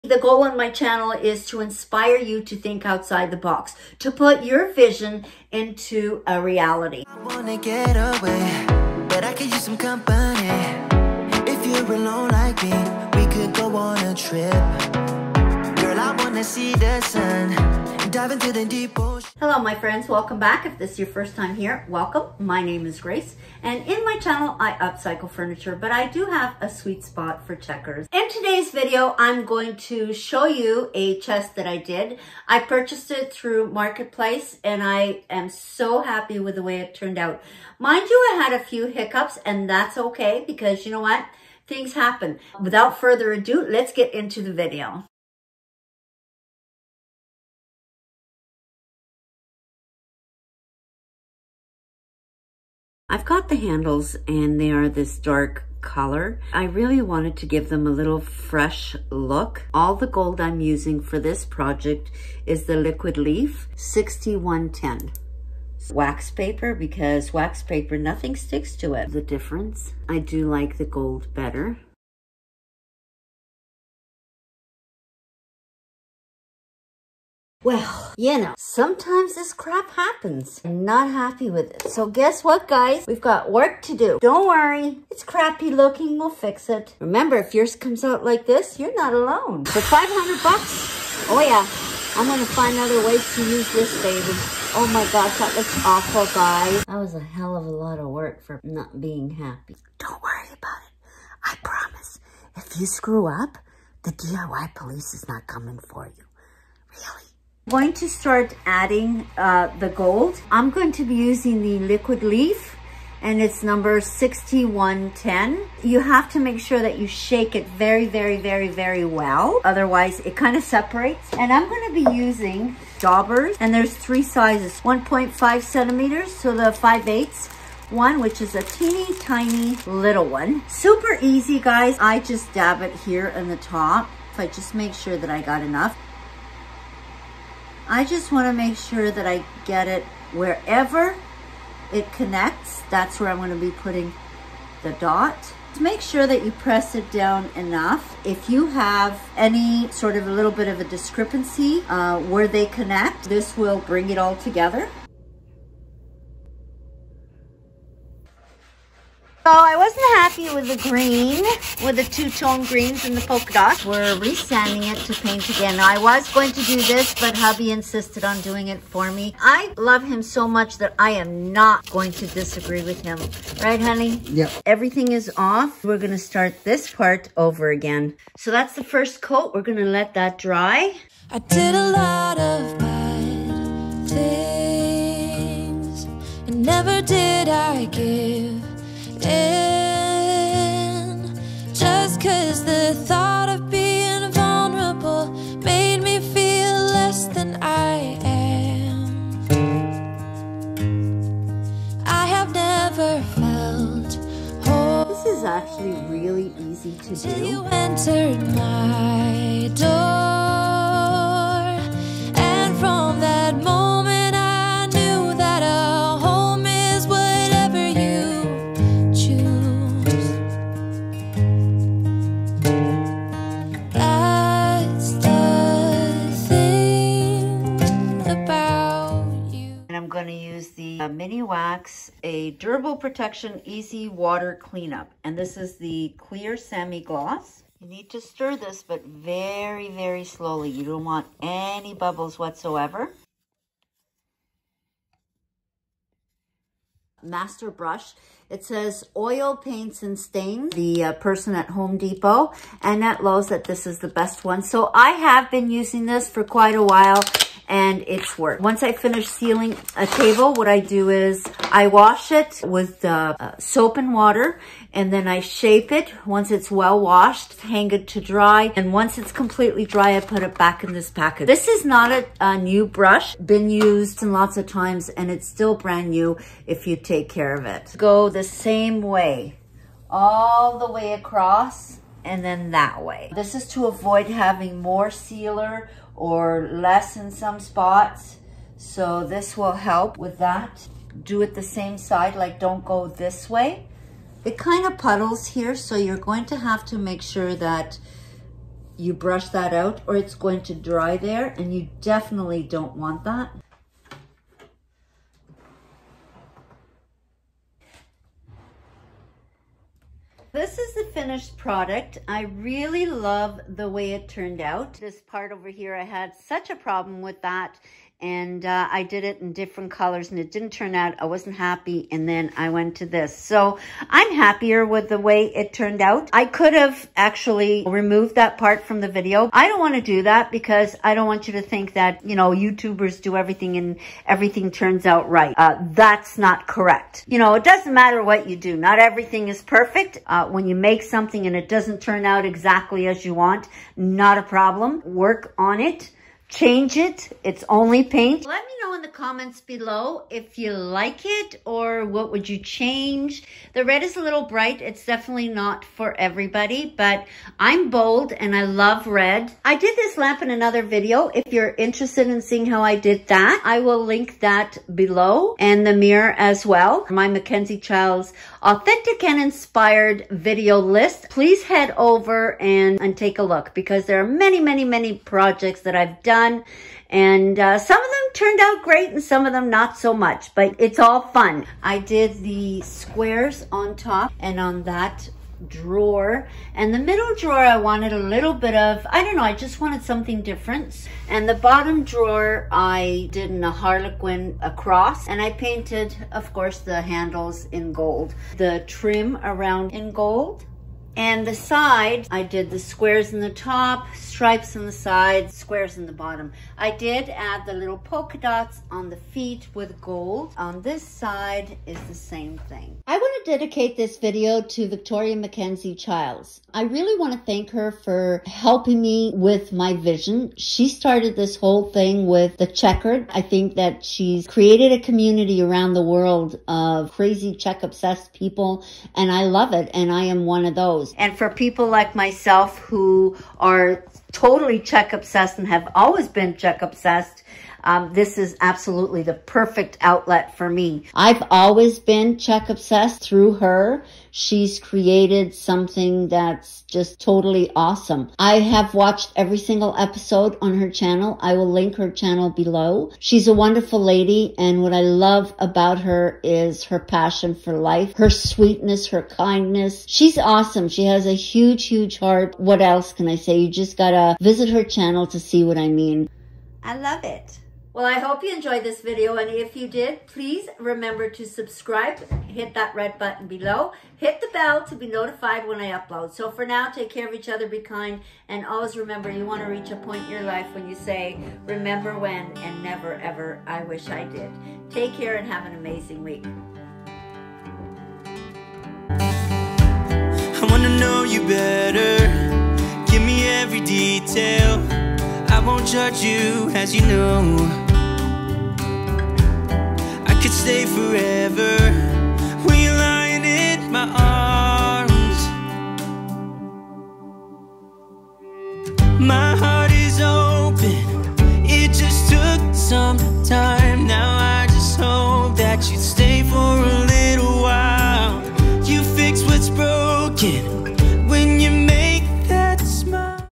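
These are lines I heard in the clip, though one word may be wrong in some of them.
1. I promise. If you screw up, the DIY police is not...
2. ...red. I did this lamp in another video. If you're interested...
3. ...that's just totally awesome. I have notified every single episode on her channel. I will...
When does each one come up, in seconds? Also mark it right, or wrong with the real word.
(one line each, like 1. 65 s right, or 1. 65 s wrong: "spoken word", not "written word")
1. 101 s right
2. 359 s right
3. 446 s wrong: "watched", not "notified".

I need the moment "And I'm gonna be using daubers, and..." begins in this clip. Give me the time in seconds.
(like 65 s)
121 s.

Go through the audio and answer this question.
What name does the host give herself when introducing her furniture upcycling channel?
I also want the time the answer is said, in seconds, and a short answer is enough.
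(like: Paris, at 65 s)
Grace, at 22 s.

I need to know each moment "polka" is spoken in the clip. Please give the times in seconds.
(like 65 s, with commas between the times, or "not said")
163 s, 407 s.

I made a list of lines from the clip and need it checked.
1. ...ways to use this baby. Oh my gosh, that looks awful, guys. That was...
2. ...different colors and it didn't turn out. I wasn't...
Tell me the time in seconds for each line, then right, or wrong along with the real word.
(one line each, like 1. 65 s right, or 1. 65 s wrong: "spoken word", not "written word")
1. 93 s right
2. 319 s right.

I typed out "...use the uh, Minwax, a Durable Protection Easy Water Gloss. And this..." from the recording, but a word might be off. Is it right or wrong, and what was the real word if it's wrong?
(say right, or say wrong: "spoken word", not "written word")
wrong: "Cleanup", not "Gloss".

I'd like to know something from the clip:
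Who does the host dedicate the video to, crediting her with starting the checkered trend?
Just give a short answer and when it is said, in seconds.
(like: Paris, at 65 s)
Victoria Mackenzie Childs, at 414 s.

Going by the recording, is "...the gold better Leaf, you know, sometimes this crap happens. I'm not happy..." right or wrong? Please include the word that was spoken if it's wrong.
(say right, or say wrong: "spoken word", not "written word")
wrong: "Well", not "Leaf".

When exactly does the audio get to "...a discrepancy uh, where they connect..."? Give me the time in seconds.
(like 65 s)
150 s.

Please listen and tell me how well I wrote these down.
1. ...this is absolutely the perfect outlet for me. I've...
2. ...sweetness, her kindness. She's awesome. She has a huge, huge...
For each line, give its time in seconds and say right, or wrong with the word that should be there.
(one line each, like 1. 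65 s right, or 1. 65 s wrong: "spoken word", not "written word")
1. 438 s right
2. 458 s right.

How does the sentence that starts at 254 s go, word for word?
So I have been using this for quite a while and it's worked.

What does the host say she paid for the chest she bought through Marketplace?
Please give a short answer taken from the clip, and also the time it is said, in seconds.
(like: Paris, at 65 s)
500 bucks, at 89 s.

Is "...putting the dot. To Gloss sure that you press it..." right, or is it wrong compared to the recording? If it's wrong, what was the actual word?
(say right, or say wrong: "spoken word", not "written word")
wrong: "Make", not "Gloss".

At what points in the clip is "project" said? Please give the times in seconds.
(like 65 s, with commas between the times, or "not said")
61 s, 375 s.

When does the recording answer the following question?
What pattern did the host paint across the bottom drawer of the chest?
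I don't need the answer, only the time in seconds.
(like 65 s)
393 s.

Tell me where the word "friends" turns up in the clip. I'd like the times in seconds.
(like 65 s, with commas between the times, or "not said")
19 s.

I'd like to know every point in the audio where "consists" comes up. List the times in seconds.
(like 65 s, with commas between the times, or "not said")
not said.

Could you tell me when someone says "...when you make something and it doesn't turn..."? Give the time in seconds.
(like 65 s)
340 s.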